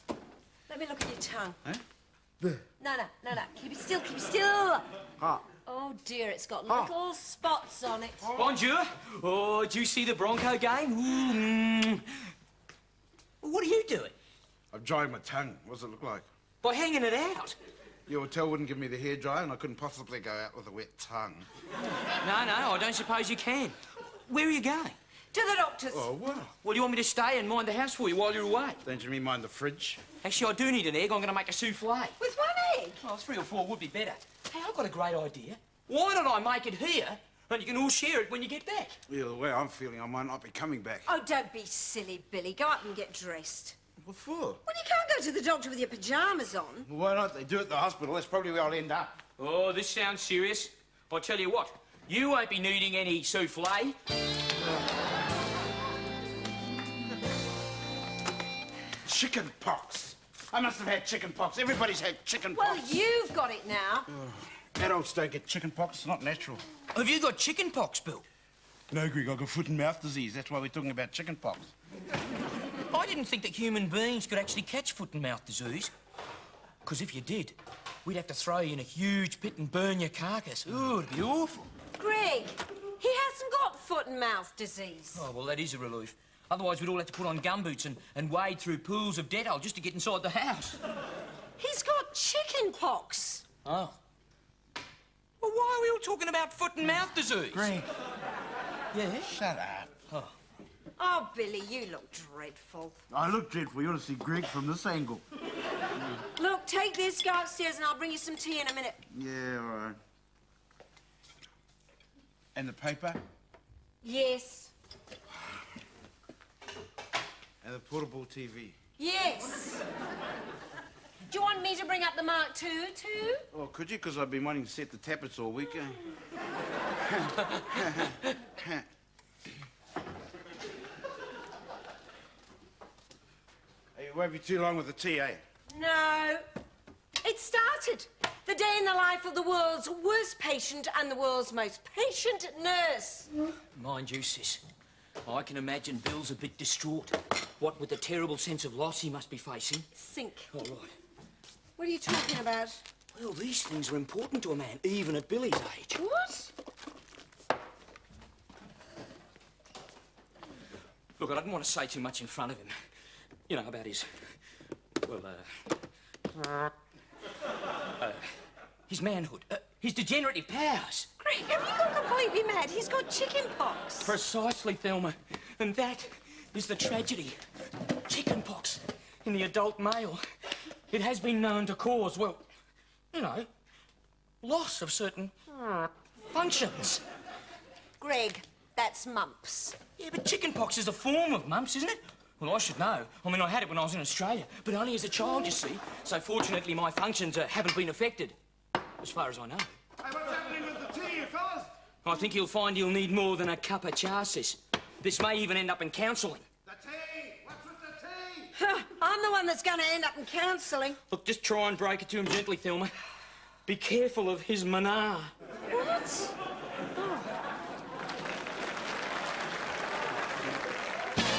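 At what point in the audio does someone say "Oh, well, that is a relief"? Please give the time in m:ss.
1:25.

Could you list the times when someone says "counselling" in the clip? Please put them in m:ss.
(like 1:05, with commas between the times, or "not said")
3:25, 3:30.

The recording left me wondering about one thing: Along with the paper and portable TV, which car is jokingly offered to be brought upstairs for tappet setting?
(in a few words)
Mark II.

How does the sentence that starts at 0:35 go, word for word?
Why don't I make it here and you can all share it when you get back?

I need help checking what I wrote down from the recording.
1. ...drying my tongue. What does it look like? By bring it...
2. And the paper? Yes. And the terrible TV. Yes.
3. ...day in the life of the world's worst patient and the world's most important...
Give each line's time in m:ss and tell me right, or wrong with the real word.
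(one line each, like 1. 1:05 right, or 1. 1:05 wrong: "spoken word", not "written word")
1. 0:14 wrong: "hanging", not "bring"
2. 1:52 wrong: "portable", not "terrible"
3. 2:18 wrong: "patient", not "important".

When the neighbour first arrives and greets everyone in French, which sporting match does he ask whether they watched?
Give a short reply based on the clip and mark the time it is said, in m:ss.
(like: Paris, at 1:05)
The Bronco game, at 0:10.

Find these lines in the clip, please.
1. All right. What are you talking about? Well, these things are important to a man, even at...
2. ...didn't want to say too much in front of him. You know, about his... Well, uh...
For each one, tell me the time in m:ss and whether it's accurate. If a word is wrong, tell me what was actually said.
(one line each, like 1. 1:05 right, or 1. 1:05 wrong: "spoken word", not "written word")
1. 2:30 right
2. 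2:41 right.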